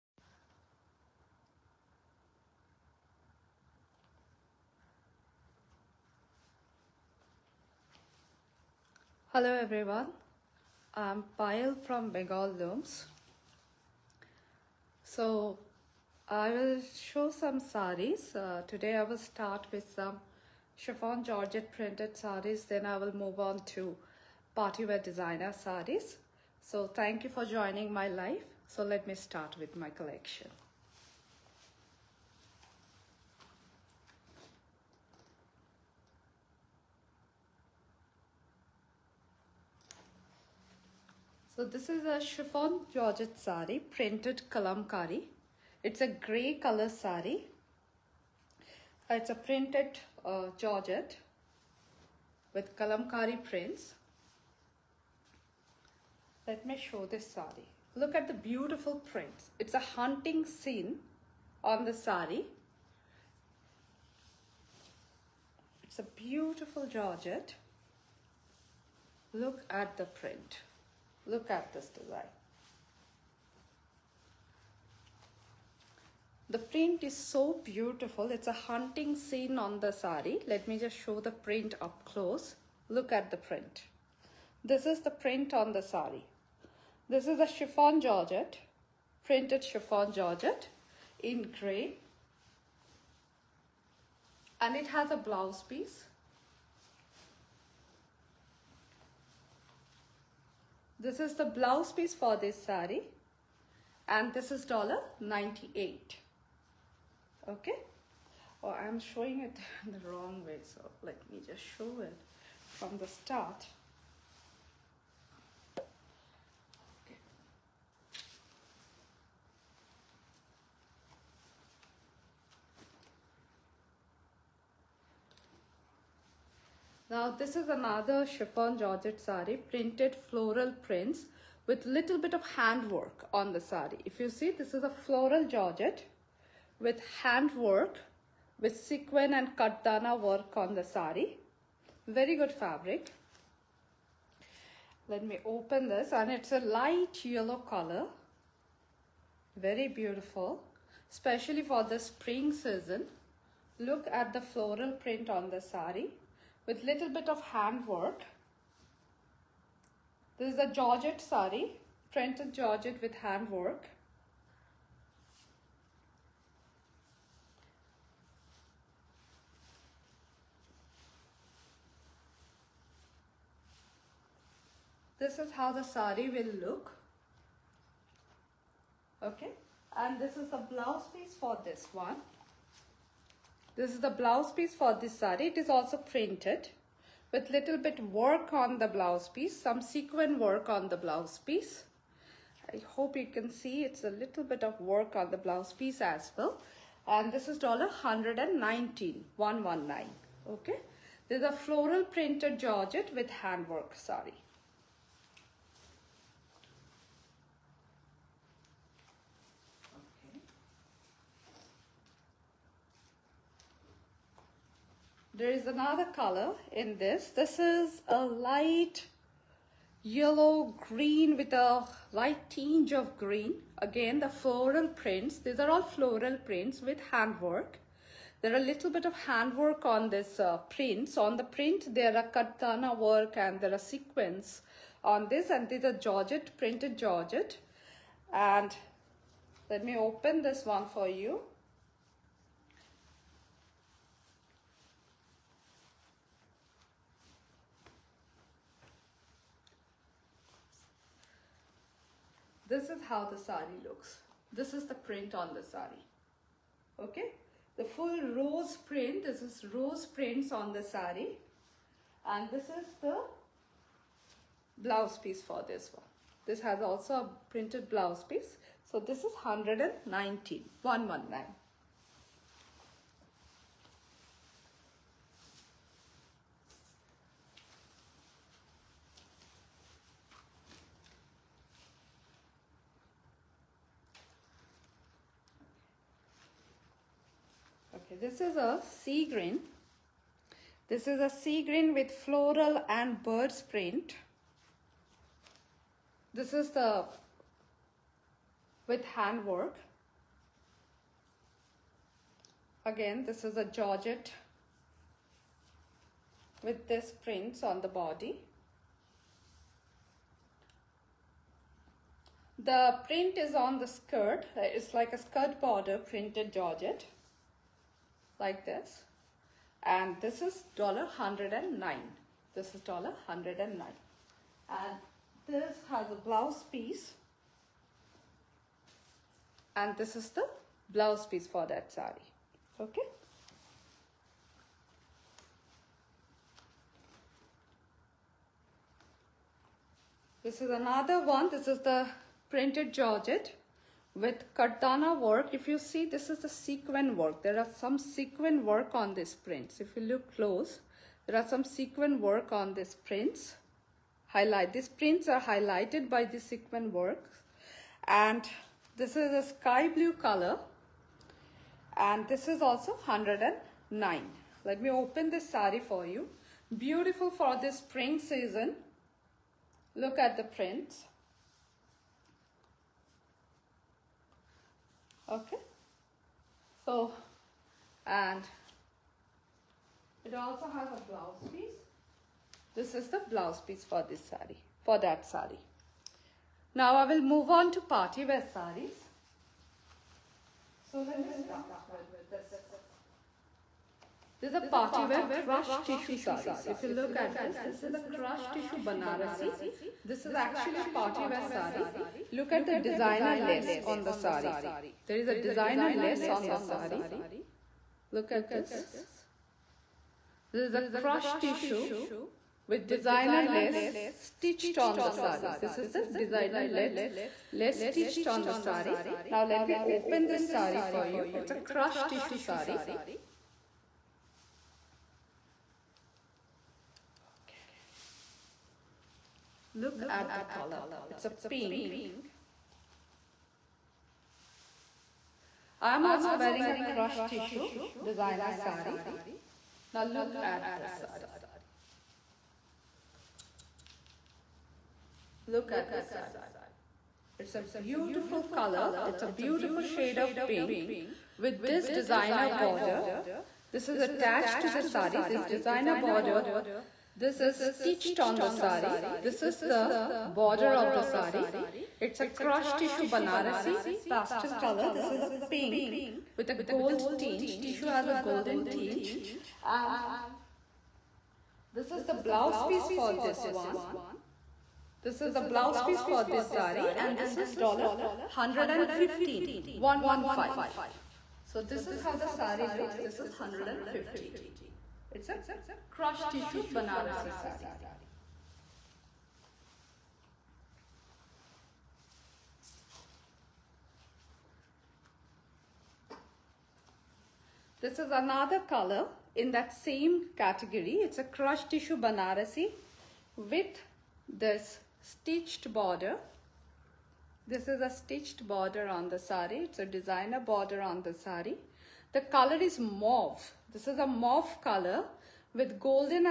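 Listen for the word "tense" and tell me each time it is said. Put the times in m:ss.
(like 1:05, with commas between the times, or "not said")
not said.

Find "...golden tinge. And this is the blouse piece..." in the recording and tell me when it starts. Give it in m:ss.
7:48.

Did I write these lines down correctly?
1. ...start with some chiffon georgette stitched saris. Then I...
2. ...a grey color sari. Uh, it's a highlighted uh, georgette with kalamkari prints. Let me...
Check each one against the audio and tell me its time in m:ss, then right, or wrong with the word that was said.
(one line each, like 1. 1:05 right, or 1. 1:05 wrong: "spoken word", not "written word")
1. 0:19 wrong: "printed", not "stitched"
2. 0:45 wrong: "printed", not "highlighted".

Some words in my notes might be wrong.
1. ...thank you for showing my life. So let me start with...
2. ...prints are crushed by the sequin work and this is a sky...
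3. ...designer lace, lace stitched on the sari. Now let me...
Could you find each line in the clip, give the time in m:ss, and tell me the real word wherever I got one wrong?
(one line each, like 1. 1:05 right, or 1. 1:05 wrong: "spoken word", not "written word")
1. 0:26 wrong: "joining", not "showing"
2. 5:54 wrong: "highlighted", not "crushed"
3. 6:56 right.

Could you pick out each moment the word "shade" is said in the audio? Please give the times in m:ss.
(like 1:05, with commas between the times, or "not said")
7:29.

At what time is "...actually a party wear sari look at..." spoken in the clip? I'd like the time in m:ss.
6:40.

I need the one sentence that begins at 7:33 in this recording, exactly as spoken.
This is attached to the sari.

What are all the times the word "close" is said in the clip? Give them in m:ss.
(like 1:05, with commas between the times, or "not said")
1:22, 5:50.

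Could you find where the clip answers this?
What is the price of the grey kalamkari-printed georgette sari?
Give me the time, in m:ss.
1:44.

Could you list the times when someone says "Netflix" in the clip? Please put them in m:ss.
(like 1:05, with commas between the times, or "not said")
not said.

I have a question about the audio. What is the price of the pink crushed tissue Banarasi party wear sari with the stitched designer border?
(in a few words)
$115.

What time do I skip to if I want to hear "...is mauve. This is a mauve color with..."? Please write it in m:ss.
8:32.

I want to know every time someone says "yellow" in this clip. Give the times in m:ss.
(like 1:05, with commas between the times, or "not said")
2:27, 3:40.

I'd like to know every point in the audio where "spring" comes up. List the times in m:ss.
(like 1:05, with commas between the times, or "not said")
2:31, 6:07.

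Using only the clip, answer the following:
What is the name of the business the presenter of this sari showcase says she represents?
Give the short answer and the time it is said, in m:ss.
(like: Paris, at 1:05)
Bengal Looms, at 0:12.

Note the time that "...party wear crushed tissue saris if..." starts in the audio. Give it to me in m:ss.
6:34.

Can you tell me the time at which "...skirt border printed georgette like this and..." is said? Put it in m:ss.
5:15.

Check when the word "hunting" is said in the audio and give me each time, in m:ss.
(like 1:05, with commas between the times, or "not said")
0:59, 1:18.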